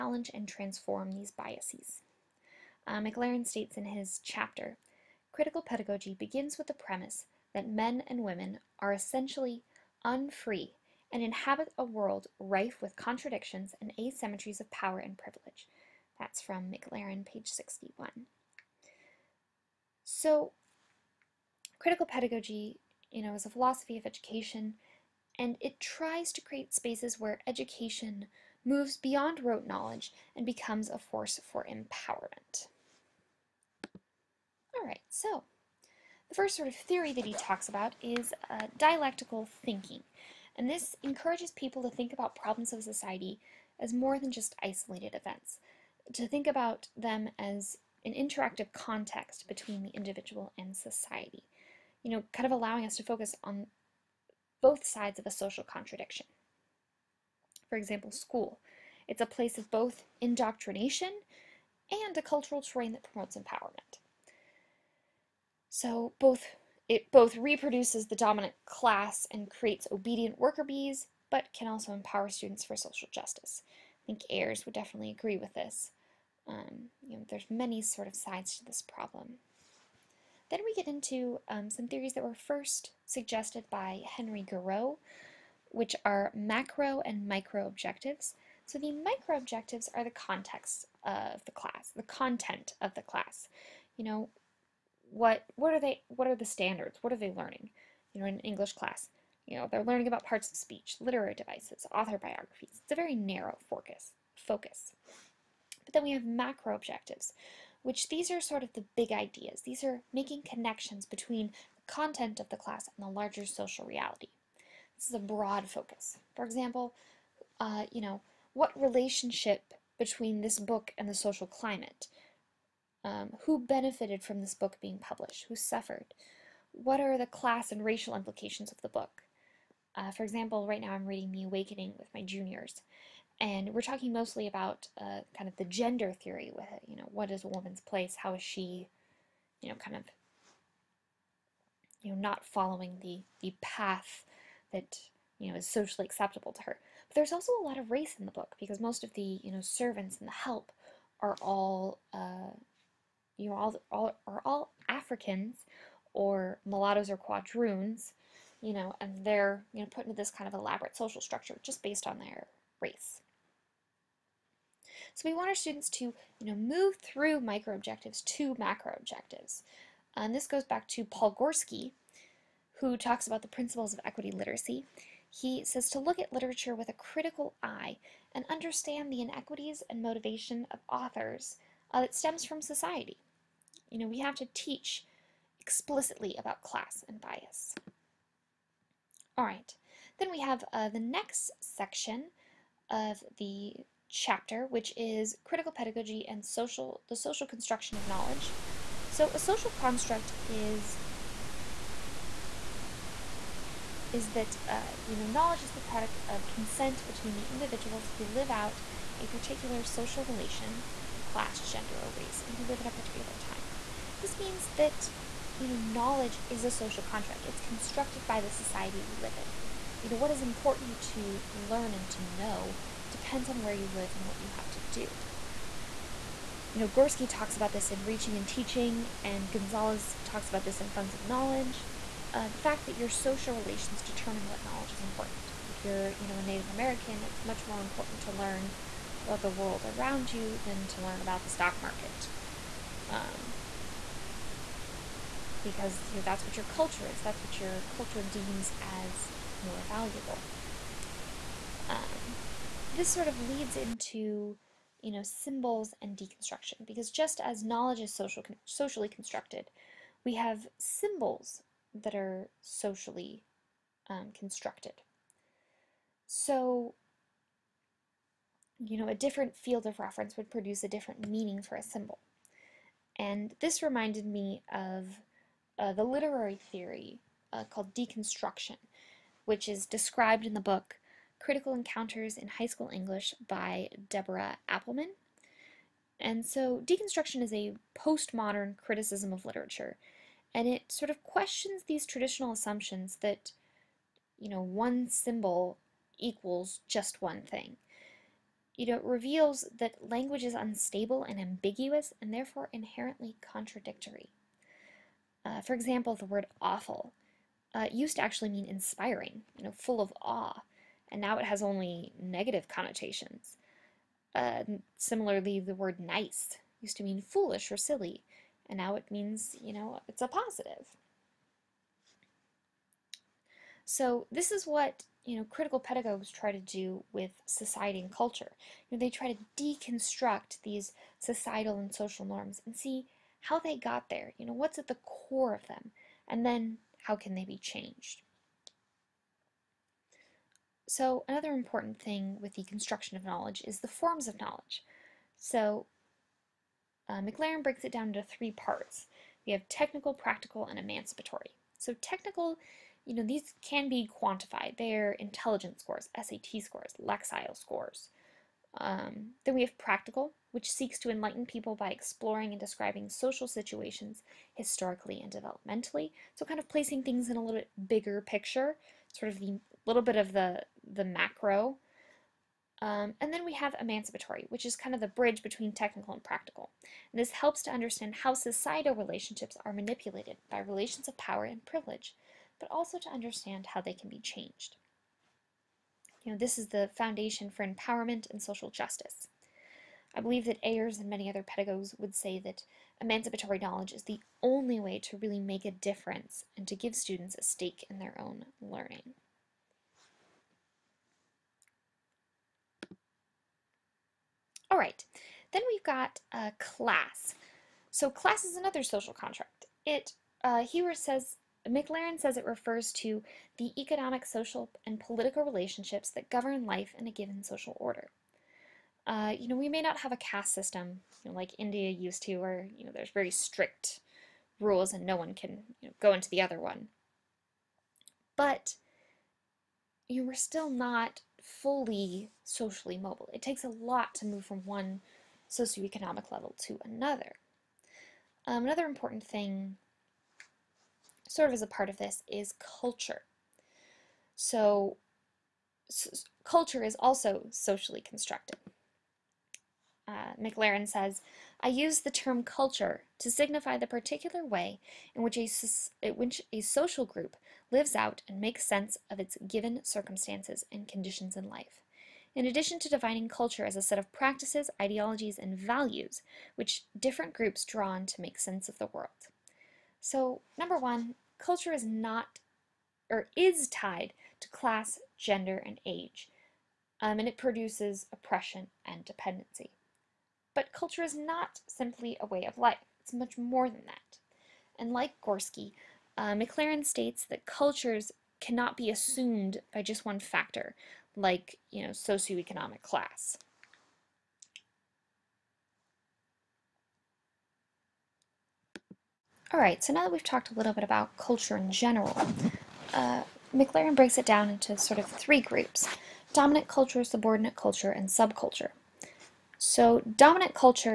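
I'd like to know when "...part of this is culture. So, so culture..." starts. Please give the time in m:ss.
7:21.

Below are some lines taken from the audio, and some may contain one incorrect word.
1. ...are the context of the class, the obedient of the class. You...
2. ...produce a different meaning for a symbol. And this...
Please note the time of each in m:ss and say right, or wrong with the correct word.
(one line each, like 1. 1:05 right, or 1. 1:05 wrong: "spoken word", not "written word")
1. 1:29 wrong: "content", not "obedient"
2. 4:30 right.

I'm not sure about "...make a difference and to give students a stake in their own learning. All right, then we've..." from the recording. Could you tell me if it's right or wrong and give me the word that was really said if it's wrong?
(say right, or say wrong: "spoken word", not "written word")
right.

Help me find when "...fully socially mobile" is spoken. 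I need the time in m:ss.
7:11.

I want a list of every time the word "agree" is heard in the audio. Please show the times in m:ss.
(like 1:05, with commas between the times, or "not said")
1:15.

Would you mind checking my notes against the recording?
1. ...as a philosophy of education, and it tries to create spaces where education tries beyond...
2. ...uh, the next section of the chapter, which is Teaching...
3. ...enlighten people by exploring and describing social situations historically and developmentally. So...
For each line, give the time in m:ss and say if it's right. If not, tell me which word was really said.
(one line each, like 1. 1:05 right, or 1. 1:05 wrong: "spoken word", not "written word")
1. 0:23 wrong: "moves", not "tries"
2. 3:10 wrong: "Critical", not "Teaching"
3. 6:01 right.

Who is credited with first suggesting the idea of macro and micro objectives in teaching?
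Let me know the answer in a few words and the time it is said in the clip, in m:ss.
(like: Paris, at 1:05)
Henry Giroux, at 1:24.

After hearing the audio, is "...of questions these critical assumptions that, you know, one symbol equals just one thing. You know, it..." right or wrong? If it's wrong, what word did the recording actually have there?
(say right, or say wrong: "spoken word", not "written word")
wrong: "traditional", not "critical".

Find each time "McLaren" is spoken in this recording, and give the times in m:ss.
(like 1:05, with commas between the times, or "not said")
0:02, 0:16, 5:47, 6:51, 7:30, 8:06, 8:23.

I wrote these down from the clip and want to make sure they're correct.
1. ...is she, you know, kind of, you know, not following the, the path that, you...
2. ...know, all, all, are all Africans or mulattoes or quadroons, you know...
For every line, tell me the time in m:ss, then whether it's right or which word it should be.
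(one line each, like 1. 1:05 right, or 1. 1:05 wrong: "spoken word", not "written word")
1. 2:18 right
2. 2:33 right.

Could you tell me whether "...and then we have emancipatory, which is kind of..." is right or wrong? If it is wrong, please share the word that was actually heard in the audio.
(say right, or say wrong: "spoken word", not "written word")
right.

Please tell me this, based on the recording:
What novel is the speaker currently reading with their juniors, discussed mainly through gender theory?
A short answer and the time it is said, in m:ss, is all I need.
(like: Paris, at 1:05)
The Awakening, at 2:11.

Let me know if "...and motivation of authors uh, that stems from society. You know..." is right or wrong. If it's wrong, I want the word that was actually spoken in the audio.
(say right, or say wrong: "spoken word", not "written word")
right.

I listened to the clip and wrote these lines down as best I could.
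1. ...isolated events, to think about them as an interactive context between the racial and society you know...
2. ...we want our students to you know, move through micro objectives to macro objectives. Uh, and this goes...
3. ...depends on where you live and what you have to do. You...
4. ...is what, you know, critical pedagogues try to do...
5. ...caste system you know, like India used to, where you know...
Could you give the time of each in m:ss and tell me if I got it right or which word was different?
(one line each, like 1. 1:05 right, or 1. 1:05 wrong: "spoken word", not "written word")
1. 0:44 wrong: "individual", not "racial"
2. 2:45 right
3. 3:43 right
4. 5:24 right
5. 7:00 right.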